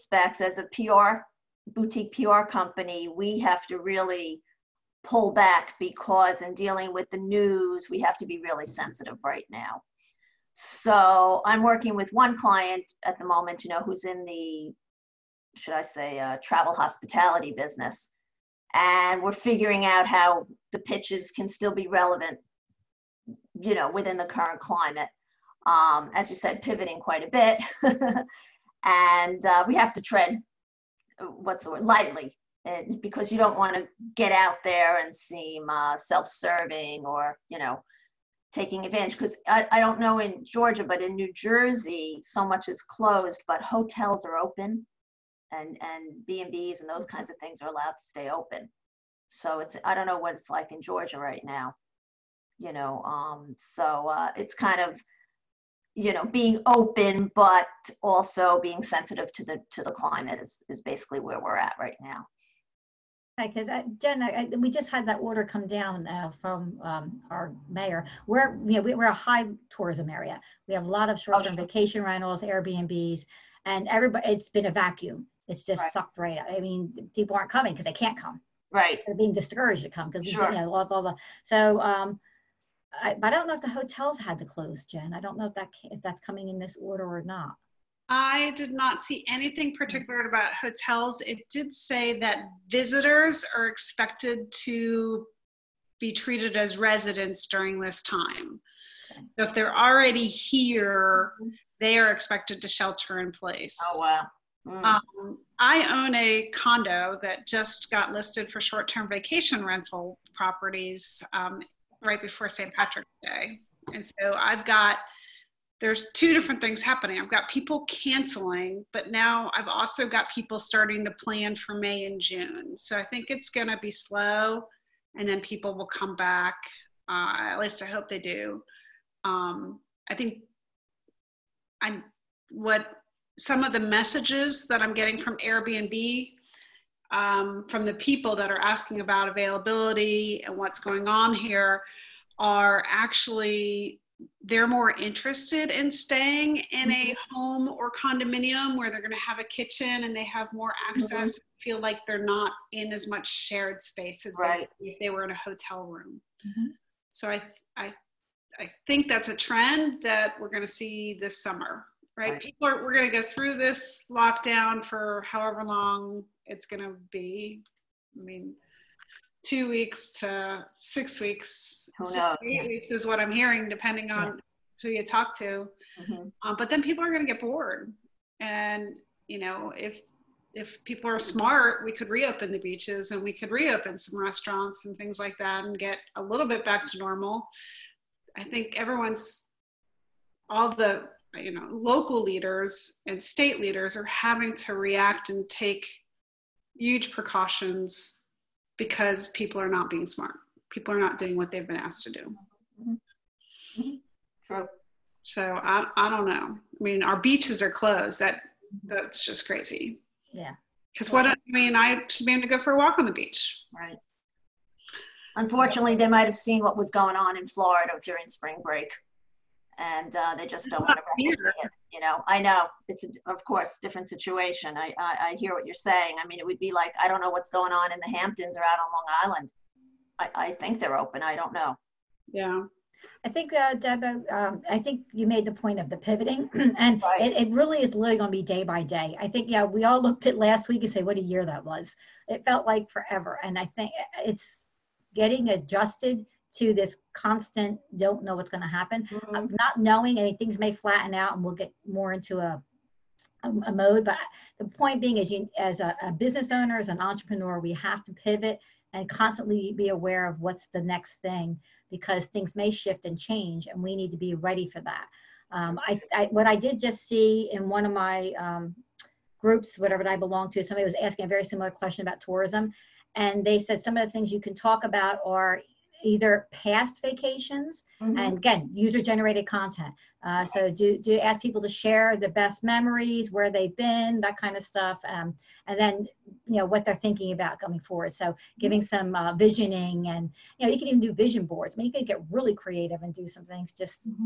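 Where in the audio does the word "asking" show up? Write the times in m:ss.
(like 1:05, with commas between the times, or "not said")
2:18, 4:30.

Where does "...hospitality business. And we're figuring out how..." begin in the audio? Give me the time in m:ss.
0:16.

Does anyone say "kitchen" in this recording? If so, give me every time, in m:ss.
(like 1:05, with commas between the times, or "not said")
2:29.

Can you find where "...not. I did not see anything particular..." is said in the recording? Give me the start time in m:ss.
1:27.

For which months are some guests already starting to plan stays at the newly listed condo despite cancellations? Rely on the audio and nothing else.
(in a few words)
May and June.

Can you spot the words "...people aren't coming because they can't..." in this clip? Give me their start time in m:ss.
1:17.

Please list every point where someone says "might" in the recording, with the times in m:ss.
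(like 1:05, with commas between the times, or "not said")
3:36.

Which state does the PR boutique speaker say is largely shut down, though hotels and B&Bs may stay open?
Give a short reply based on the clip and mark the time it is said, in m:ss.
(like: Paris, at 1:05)
New Jersey, at 0:41.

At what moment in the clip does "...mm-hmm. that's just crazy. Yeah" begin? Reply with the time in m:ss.
3:28.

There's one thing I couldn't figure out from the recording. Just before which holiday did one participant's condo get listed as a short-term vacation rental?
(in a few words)
St. Patrick's Day.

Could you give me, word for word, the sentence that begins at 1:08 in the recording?
We're you know we, are a high tourism area.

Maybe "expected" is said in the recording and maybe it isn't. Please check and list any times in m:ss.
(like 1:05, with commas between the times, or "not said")
1:33, 1:42.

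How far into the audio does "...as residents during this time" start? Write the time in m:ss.
1:36.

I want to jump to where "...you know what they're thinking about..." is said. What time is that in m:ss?
4:46.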